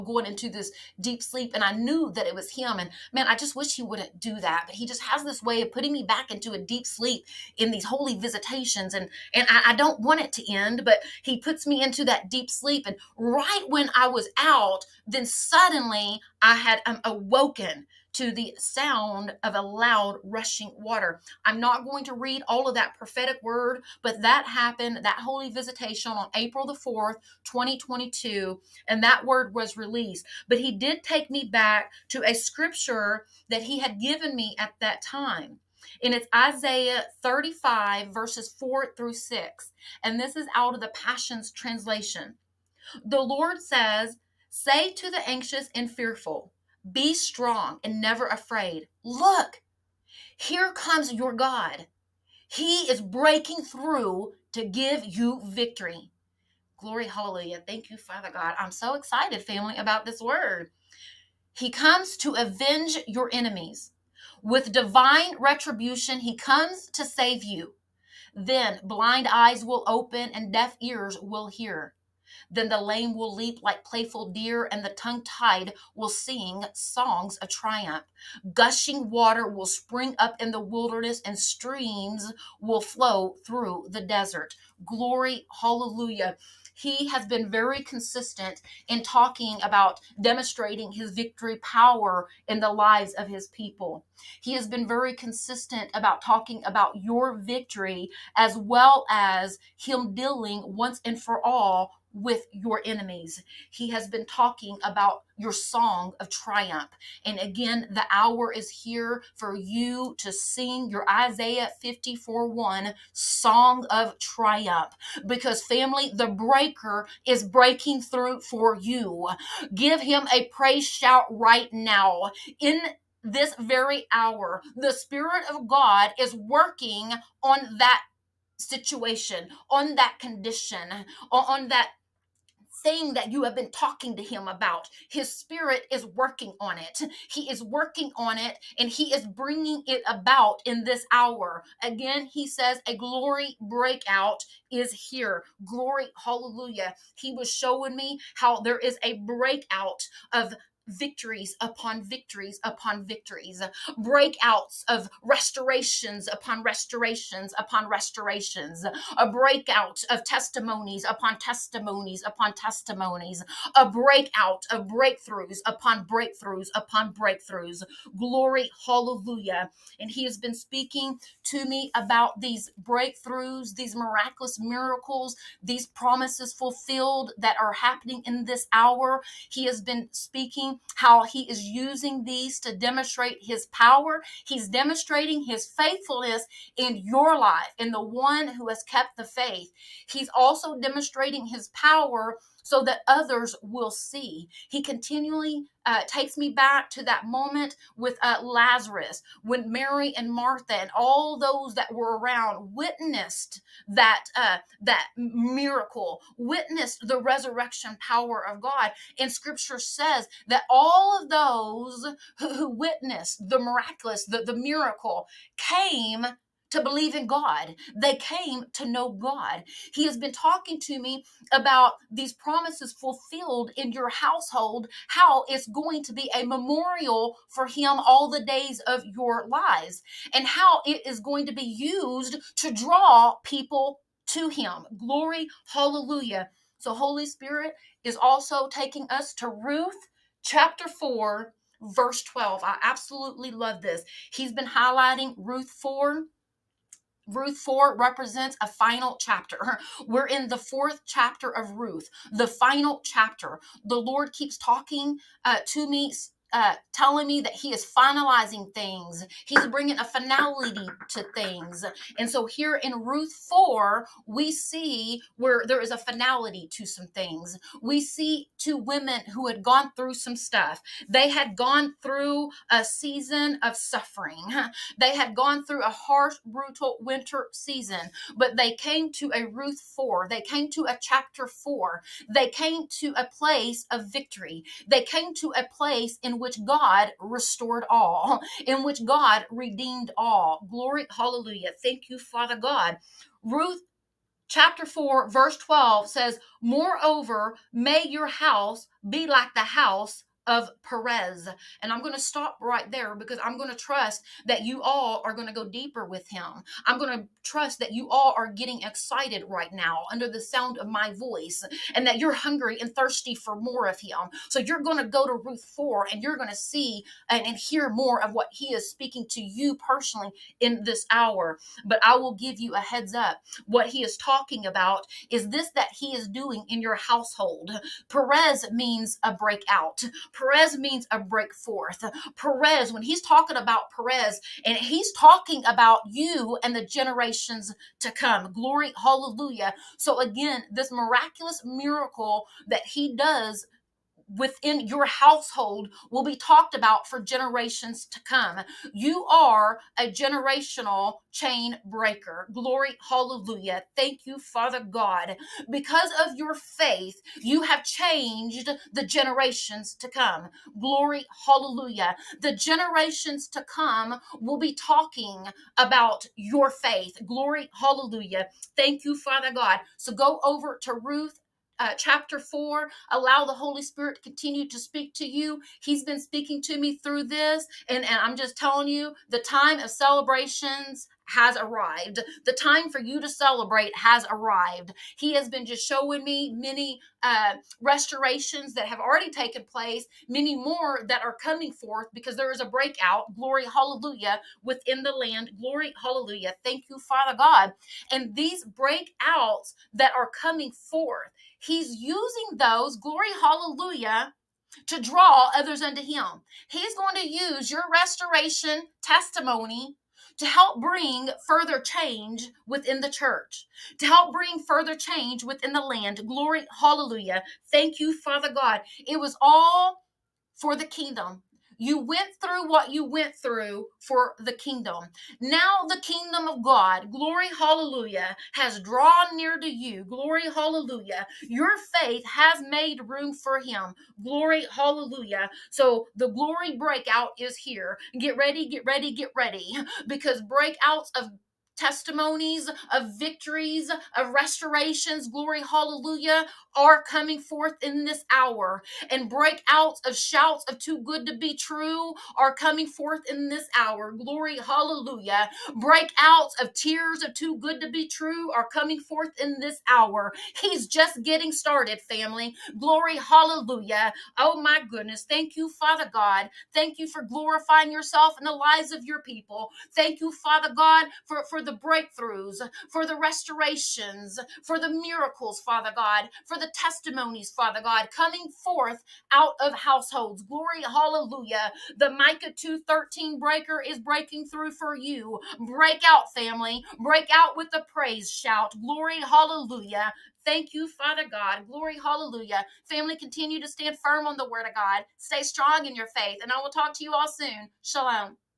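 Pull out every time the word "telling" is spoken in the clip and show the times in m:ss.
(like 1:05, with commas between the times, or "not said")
4:16, 6:18.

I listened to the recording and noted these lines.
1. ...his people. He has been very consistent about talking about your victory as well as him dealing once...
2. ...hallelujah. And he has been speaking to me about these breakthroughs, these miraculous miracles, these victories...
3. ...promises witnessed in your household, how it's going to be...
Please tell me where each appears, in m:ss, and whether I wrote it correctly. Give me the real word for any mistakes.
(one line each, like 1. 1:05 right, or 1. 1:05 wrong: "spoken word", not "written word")
1. 1:33 right
2. 2:48 wrong: "promises", not "victories"
3. 3:42 wrong: "fulfilled", not "witnessed".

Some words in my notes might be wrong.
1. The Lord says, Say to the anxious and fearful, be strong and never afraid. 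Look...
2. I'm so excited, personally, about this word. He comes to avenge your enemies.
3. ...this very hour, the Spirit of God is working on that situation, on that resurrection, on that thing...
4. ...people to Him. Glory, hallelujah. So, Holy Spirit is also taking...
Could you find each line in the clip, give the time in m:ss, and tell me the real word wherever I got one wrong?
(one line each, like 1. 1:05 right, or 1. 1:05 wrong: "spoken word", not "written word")
1. 0:43 right
2. 0:58 wrong: "family", not "personally"
3. 2:03 wrong: "condition", not "resurrection"
4. 3:53 right.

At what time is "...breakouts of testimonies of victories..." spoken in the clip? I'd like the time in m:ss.
7:20.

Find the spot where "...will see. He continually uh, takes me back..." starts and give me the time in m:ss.
3:13.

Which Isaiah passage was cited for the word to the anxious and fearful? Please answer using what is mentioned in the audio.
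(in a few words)
Isaiah 35:4-6.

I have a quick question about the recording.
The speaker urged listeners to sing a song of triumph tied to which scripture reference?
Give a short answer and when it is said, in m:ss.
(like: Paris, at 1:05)
Isaiah 54:1, at 1:51.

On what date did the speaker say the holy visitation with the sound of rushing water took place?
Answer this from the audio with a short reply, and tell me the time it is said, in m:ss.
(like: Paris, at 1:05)
April 4, 2022, at 0:26.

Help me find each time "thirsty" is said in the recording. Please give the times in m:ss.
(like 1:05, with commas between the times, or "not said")
5:12.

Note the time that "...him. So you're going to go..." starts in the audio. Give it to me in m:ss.
5:13.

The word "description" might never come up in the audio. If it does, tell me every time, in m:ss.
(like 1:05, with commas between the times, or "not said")
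not said.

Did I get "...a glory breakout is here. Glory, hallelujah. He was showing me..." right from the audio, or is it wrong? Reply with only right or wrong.
right.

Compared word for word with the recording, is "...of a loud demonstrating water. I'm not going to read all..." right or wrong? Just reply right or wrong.
wrong.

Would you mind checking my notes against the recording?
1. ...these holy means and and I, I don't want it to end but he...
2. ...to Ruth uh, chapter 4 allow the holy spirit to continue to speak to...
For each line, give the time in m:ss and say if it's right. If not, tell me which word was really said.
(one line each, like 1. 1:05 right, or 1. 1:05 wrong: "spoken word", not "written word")
1. 0:07 wrong: "visitations", not "means"
2. 6:10 right.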